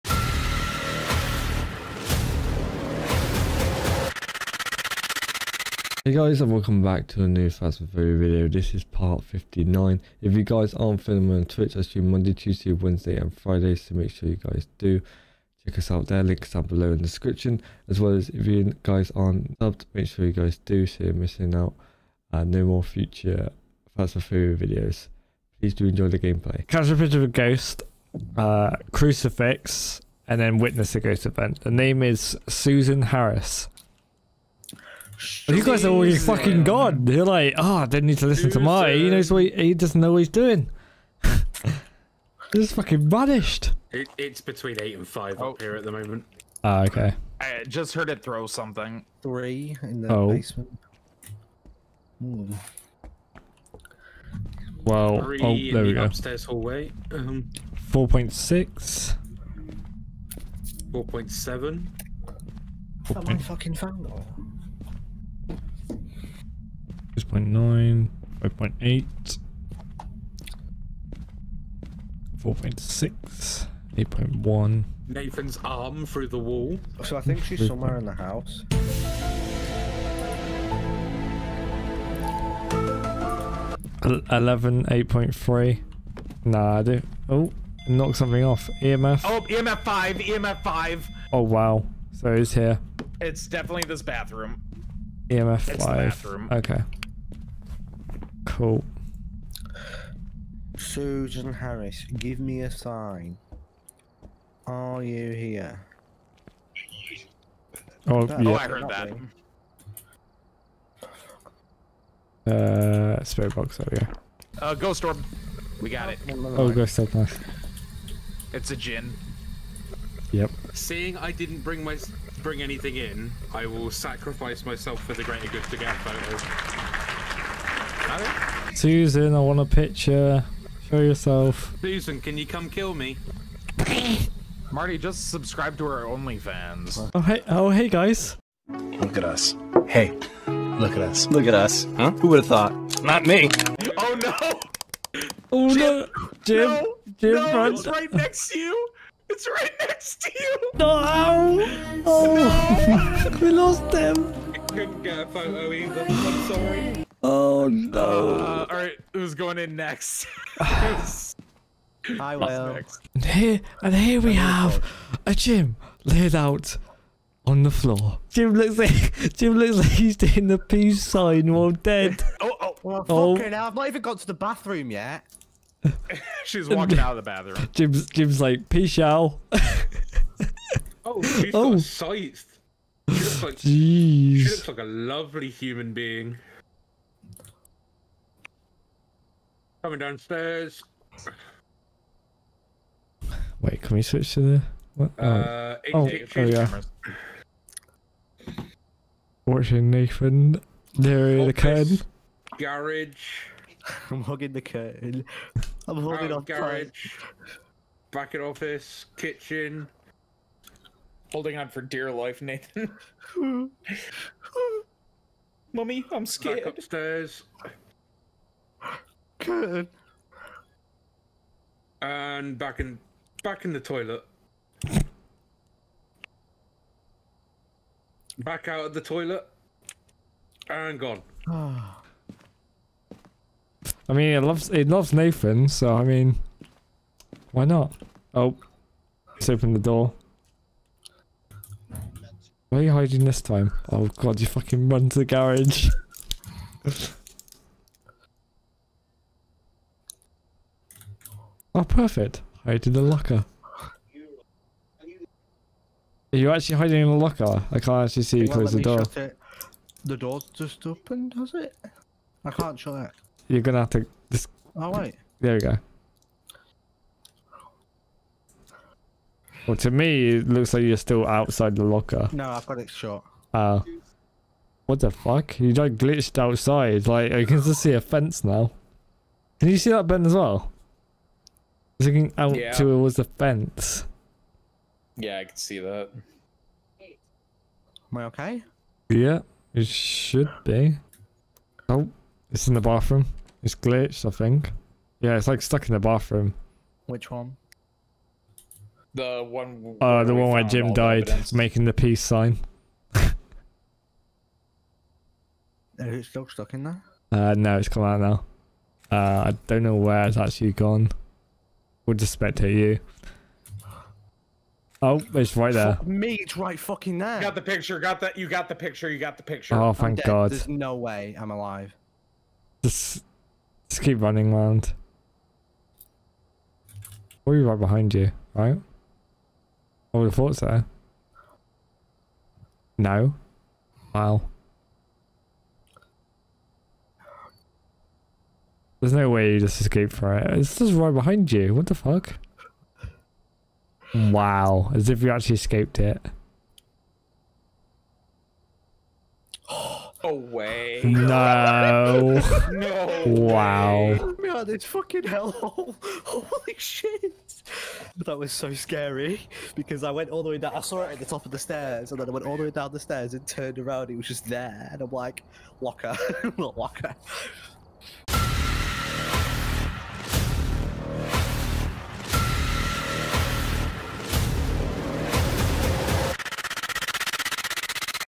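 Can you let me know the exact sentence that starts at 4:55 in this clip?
Yeah, it's like stuck in the bathroom.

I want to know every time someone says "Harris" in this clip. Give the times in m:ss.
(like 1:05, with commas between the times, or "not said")
0:33, 1:41.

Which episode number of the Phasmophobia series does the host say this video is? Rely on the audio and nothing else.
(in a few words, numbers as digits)
59.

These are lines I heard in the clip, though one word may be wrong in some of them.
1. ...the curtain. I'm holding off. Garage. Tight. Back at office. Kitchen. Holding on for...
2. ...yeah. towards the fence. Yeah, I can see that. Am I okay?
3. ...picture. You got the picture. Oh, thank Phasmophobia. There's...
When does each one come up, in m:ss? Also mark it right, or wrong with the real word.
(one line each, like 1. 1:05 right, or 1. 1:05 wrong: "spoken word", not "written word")
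1. 3:24 right
2. 4:42 right
3. 5:18 wrong: "God", not "Phasmophobia".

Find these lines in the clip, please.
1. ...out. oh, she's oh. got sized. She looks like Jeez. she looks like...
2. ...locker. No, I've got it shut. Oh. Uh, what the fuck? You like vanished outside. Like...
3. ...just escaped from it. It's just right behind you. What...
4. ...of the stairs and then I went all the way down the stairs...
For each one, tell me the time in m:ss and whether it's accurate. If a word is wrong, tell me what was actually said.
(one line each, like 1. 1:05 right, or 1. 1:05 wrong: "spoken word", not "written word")
1. 2:58 right
2. 4:31 wrong: "glitched", not "vanished"
3. 5:39 right
4. 6:01 right.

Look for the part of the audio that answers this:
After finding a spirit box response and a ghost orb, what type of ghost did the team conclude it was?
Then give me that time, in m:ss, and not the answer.
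1:58.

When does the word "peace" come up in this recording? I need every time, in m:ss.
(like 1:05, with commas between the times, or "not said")
2:50, 2:58, 5:01.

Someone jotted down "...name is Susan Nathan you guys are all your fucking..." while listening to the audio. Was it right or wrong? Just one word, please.
wrong.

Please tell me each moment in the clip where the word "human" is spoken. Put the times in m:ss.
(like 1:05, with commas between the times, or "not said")
3:05.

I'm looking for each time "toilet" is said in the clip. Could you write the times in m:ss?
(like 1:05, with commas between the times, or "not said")
3:43, 3:49.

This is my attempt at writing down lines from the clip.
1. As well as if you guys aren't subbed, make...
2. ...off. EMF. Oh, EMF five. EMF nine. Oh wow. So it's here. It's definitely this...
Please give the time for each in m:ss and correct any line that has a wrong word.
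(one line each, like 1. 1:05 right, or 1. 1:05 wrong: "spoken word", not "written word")
1. 0:17 right
2. 1:28 wrong: "five", not "nine".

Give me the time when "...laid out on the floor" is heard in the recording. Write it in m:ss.
2:46.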